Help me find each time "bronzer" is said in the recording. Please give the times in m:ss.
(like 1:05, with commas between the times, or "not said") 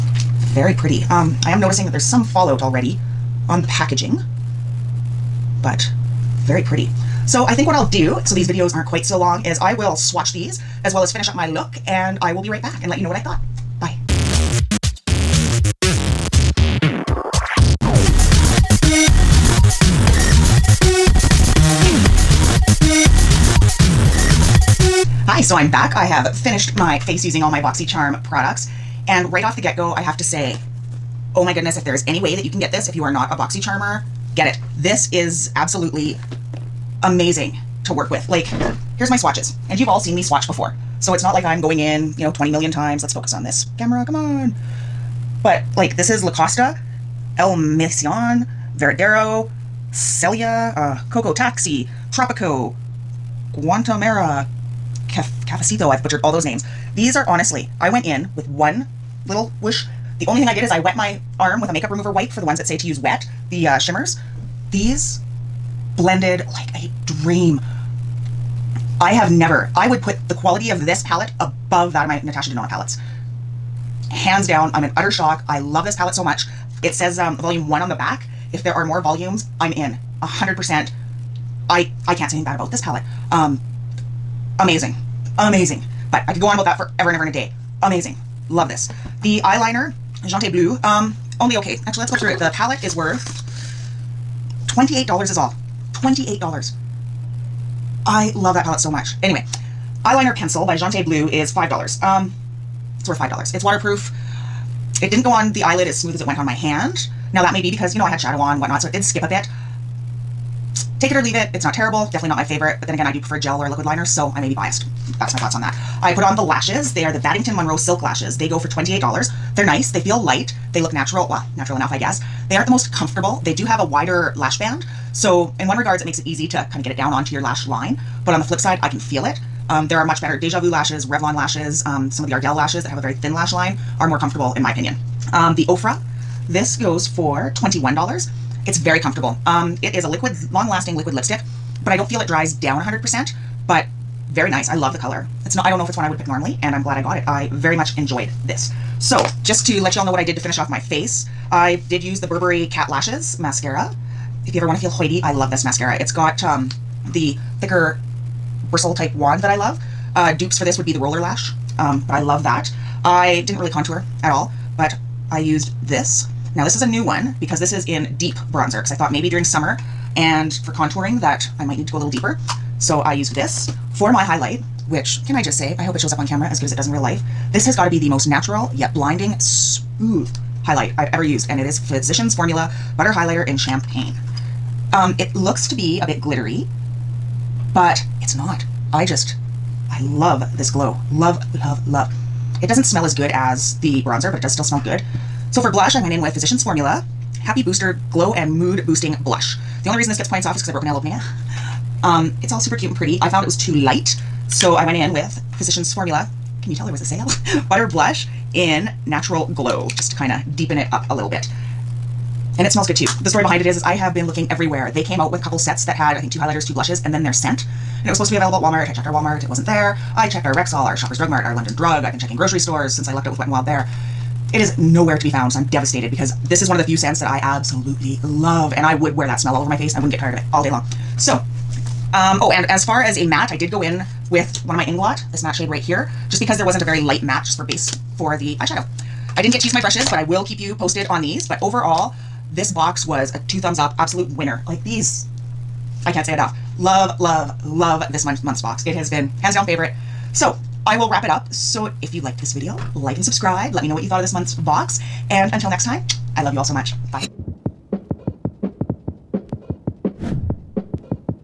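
2:48, 3:14.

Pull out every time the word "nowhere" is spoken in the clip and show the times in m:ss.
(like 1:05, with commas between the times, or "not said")
3:44.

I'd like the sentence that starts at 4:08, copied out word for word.
It has been hands down favorite.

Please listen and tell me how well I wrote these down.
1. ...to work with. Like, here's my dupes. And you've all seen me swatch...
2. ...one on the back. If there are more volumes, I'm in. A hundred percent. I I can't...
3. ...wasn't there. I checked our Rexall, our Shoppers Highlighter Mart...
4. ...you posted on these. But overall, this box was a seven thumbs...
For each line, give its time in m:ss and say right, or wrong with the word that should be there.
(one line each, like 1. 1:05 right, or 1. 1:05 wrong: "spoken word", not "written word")
1. 0:37 wrong: "swatches", not "dupes"
2. 1:17 right
3. 3:39 wrong: "Drug", not "Highlighter"
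4. 4:00 wrong: "two", not "seven".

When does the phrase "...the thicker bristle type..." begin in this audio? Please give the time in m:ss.
2:37.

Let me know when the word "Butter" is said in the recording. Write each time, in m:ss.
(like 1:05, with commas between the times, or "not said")
3:02, 3:27.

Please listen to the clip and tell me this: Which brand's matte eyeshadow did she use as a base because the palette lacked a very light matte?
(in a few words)
Inglot.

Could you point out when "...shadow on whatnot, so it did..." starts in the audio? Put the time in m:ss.
1:48.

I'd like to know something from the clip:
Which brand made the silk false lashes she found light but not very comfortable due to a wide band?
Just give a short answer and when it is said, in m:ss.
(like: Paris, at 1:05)
Battington Monroe, at 1:57.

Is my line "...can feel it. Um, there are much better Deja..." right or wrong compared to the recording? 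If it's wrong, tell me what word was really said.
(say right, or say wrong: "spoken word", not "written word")
right.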